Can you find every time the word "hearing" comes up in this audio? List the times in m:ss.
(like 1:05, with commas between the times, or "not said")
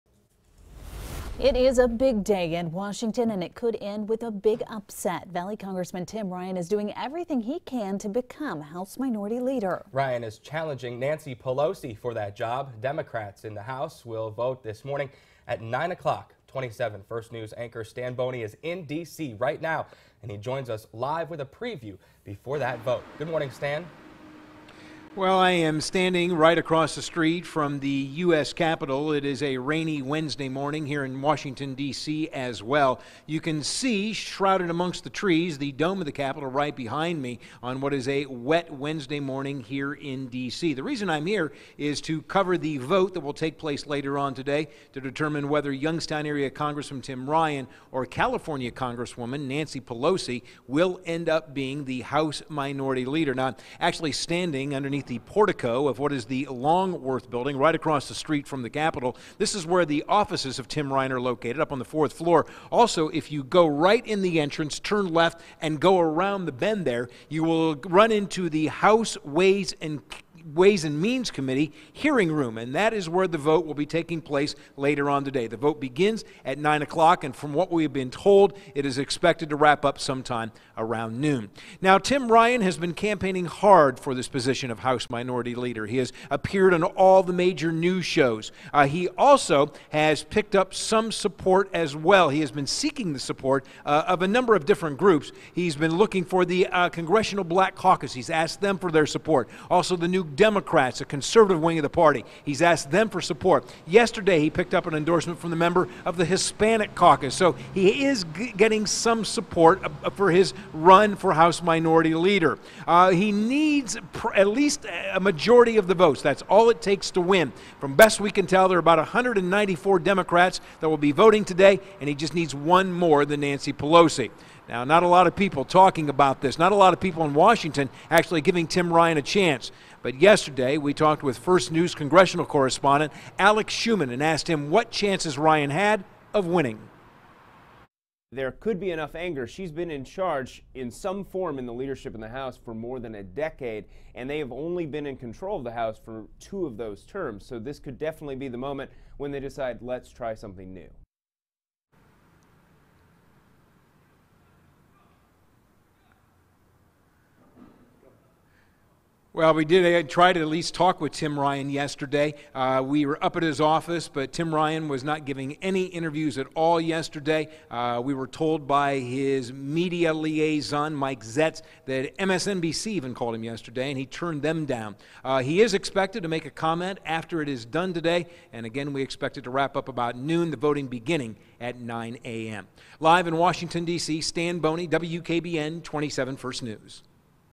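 1:11.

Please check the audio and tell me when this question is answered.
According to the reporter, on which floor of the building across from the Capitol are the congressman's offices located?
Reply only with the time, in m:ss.
1:01.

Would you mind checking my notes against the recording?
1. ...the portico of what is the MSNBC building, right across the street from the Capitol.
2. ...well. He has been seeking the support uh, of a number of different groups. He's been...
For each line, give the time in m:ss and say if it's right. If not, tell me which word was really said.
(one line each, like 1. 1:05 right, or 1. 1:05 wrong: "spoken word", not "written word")
1. 0:55 wrong: "Longworth", not "MSNBC"
2. 1:31 right.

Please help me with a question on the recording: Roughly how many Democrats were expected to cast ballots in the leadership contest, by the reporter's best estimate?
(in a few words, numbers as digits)
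194.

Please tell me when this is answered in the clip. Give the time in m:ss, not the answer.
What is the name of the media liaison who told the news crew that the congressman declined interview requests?
2:50.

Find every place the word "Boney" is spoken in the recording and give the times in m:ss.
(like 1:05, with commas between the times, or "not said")
0:18, 3:04.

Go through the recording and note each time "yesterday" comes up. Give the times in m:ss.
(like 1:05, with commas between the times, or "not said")
1:43, 2:10, 2:41, 2:46, 2:53.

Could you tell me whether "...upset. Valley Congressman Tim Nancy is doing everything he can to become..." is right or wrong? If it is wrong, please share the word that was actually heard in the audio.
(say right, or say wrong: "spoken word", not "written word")
wrong: "Ryan", not "Nancy".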